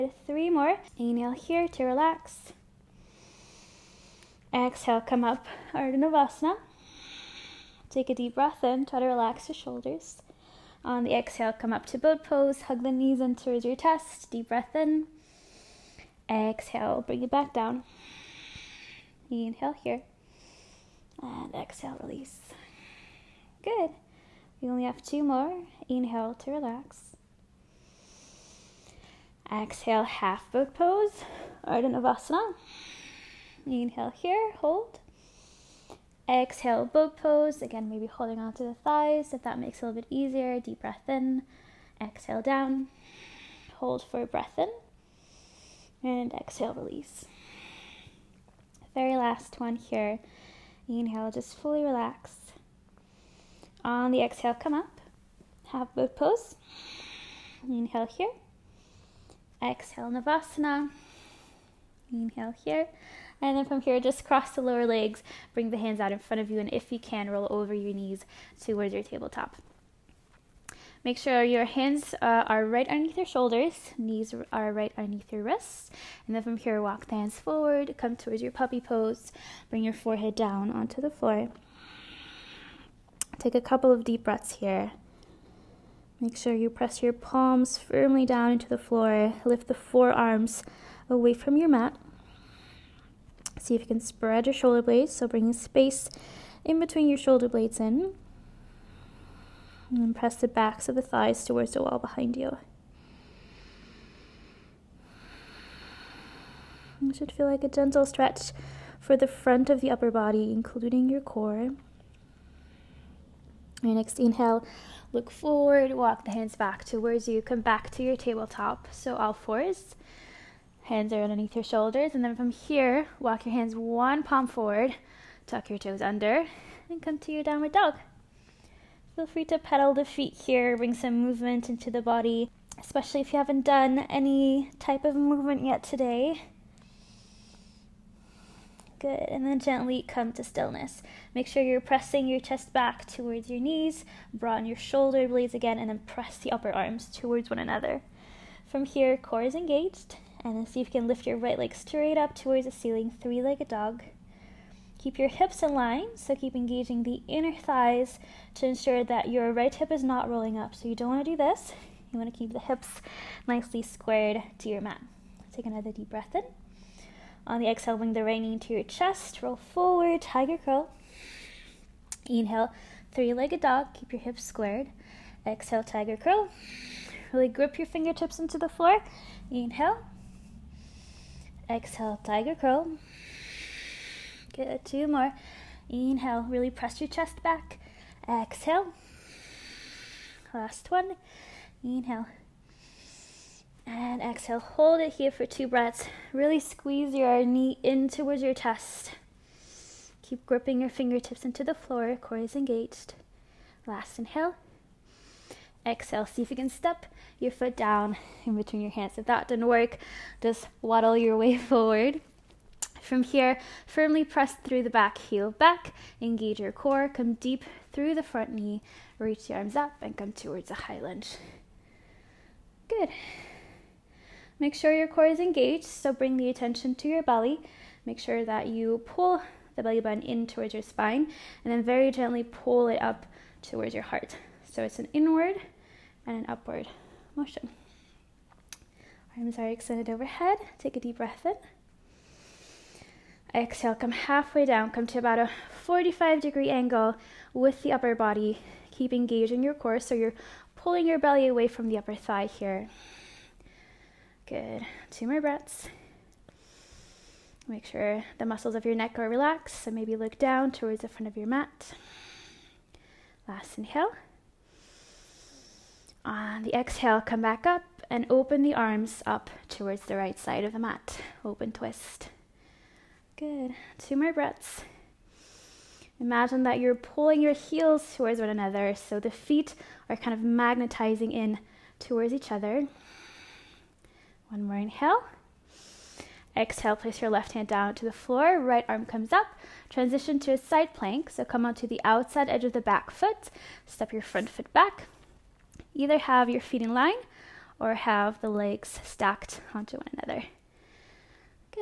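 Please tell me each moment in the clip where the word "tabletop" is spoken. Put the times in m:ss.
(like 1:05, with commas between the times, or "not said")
1:09, 1:58.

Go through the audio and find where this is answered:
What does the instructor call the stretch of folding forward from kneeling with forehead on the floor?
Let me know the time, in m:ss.
1:18.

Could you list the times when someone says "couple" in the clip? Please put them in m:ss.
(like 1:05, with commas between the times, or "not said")
1:23.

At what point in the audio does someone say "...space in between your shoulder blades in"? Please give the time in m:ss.
1:35.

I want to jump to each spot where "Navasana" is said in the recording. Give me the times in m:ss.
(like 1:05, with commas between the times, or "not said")
0:05, 0:31, 1:00.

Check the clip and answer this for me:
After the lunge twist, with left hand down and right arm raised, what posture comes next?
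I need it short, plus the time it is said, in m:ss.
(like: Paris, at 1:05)
side plank, at 4:50.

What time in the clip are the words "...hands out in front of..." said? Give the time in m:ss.
1:05.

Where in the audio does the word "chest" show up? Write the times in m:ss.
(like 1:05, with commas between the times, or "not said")
0:13, 2:22, 2:48, 3:07, 3:18.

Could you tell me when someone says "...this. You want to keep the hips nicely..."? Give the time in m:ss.
2:41.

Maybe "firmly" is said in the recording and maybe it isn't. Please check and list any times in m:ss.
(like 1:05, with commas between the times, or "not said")
1:27, 3:33.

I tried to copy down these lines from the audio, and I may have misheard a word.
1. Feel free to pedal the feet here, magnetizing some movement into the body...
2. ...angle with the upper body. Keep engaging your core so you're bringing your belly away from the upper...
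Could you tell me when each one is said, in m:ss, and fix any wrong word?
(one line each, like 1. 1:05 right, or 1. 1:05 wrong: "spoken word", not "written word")
1. 2:09 wrong: "bring", not "magnetizing"
2. 4:06 wrong: "pulling", not "bringing".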